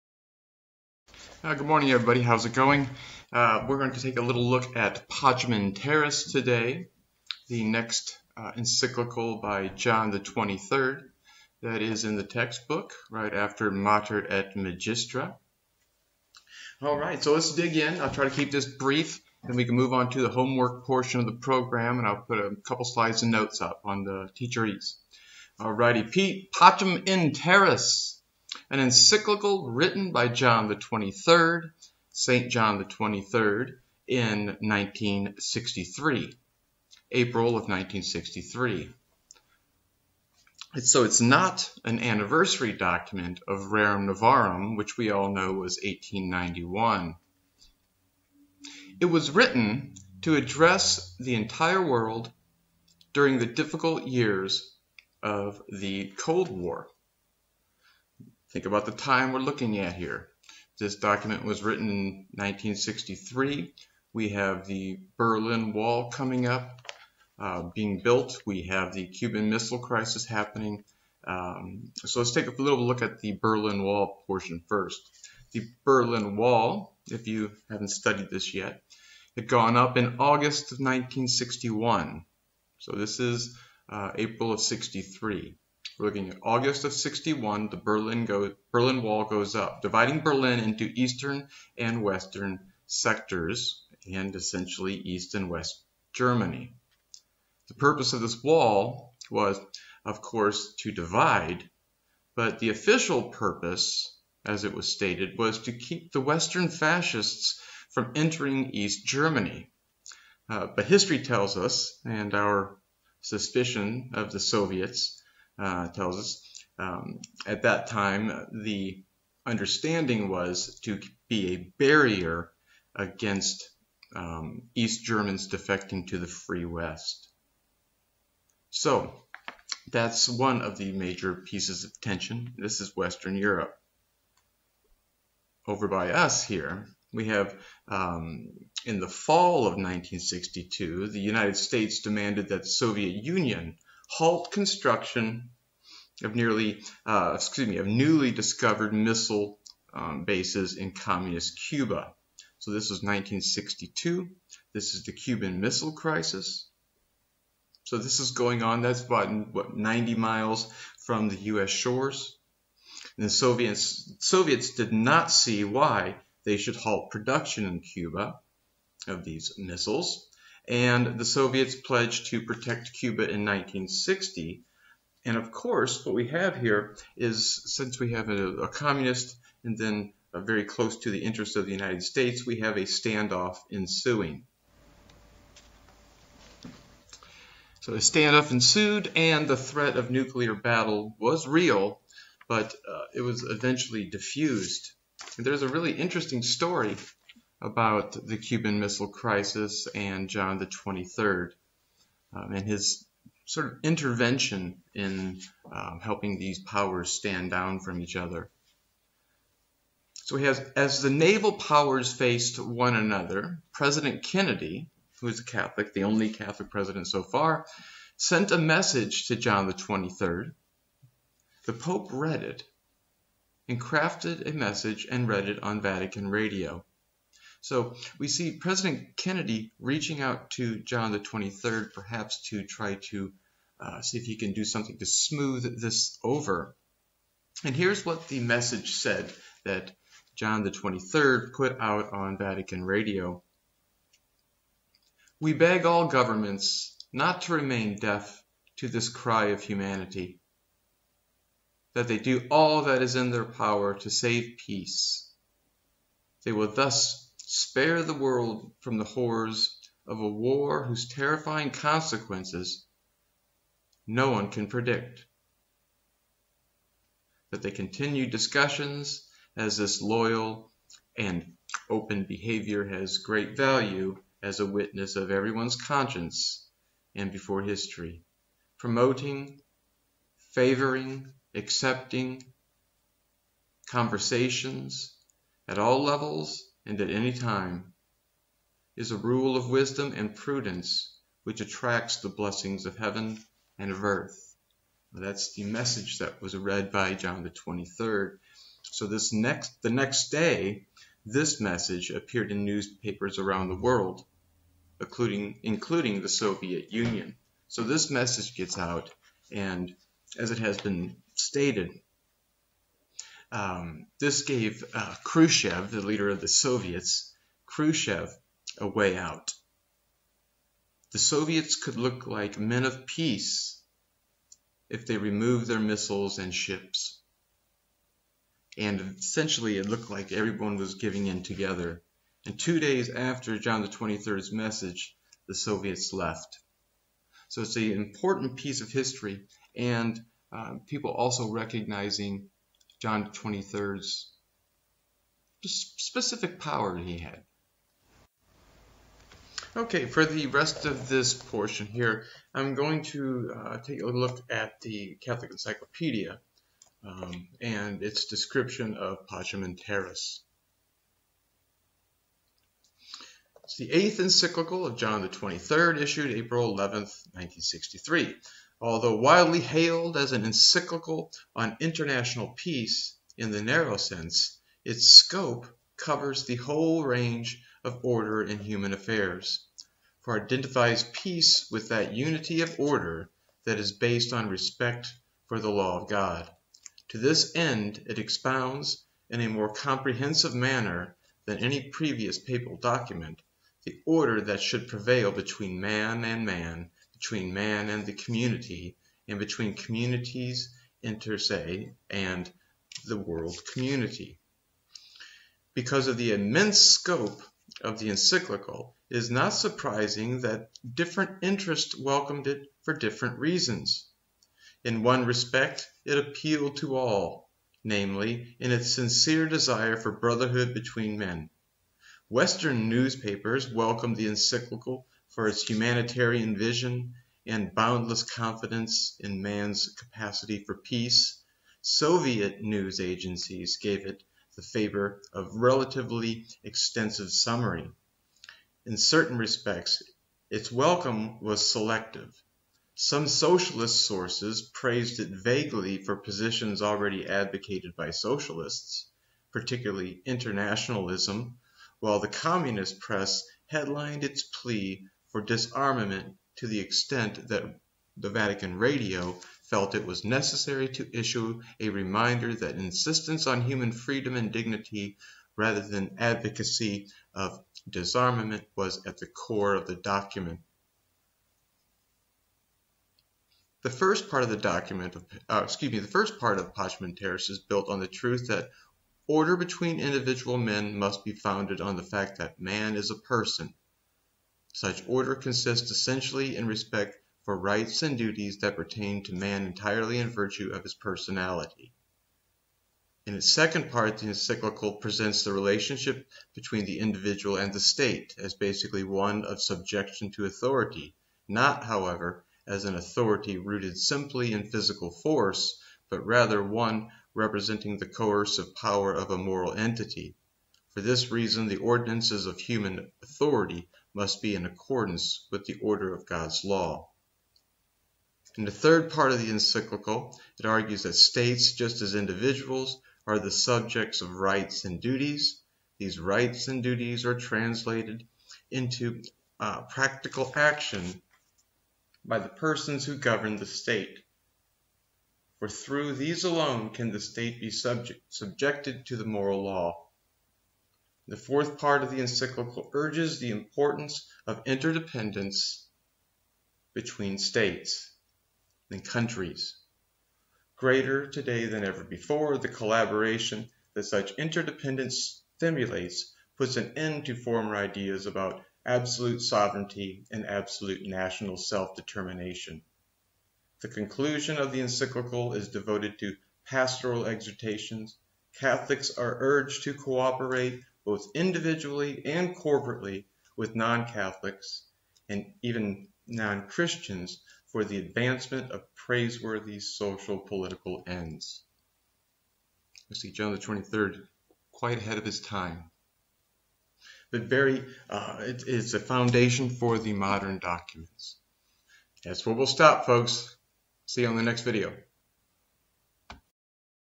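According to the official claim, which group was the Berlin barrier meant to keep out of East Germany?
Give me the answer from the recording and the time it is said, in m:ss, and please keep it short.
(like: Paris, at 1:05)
western fascists, at 1:46.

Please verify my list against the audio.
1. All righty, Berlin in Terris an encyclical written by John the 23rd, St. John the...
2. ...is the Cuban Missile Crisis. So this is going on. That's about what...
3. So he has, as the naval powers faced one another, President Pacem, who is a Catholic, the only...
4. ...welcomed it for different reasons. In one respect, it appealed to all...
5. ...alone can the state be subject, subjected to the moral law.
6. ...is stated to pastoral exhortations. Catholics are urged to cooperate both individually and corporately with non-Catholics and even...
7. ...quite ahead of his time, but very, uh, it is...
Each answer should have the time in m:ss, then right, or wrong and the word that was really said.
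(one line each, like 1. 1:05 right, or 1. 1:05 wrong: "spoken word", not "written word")
1. 0:25 wrong: "Pacem", not "Berlin"
2. 2:34 right
3. 3:30 wrong: "Kennedy", not "Pacem"
4. 6:51 right
5. 8:56 right
6. 9:25 wrong: "devoted", not "stated"
7. 9:44 right.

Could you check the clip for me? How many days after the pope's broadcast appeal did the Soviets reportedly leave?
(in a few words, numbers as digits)
2.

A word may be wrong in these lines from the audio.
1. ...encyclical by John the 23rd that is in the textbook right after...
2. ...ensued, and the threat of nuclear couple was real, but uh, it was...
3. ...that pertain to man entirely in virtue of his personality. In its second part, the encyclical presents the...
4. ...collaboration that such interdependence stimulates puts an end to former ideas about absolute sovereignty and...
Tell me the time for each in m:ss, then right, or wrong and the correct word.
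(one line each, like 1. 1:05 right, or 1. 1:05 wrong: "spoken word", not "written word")
1. 0:08 right
2. 3:08 wrong: "battle", not "couple"
3. 8:08 right
4. 9:12 right.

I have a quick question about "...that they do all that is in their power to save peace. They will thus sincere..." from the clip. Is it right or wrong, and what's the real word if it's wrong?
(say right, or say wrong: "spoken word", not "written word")
wrong: "spare", not "sincere".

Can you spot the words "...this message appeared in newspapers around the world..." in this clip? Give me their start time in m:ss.
5:01.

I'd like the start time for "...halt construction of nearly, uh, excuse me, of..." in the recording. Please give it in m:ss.
2:24.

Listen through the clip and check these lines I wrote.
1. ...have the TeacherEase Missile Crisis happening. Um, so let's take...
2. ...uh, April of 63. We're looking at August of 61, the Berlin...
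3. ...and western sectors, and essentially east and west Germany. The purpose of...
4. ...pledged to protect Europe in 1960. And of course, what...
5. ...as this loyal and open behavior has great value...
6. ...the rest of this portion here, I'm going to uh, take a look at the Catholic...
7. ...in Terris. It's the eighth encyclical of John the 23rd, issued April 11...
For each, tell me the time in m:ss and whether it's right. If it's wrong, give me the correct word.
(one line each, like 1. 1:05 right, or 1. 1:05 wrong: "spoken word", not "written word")
1. 1:08 wrong: "Cuban", not "TeacherEase"
2. 1:23 right
3. 1:31 right
4. 2:51 wrong: "Cuba", not "Europe"
5. 4:29 right
6. 5:50 right
7. 5:59 right.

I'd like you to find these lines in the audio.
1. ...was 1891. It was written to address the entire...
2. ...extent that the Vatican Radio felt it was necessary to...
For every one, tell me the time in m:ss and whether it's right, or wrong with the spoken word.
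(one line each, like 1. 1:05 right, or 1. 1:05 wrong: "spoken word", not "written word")
1. 0:45 right
2. 7:36 right.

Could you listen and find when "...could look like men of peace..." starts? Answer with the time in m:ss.
5:21.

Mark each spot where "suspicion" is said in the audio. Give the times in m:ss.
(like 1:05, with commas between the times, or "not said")
1:53.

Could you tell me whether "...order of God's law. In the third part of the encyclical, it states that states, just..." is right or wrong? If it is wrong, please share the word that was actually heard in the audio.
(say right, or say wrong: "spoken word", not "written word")
wrong: "argues", not "states".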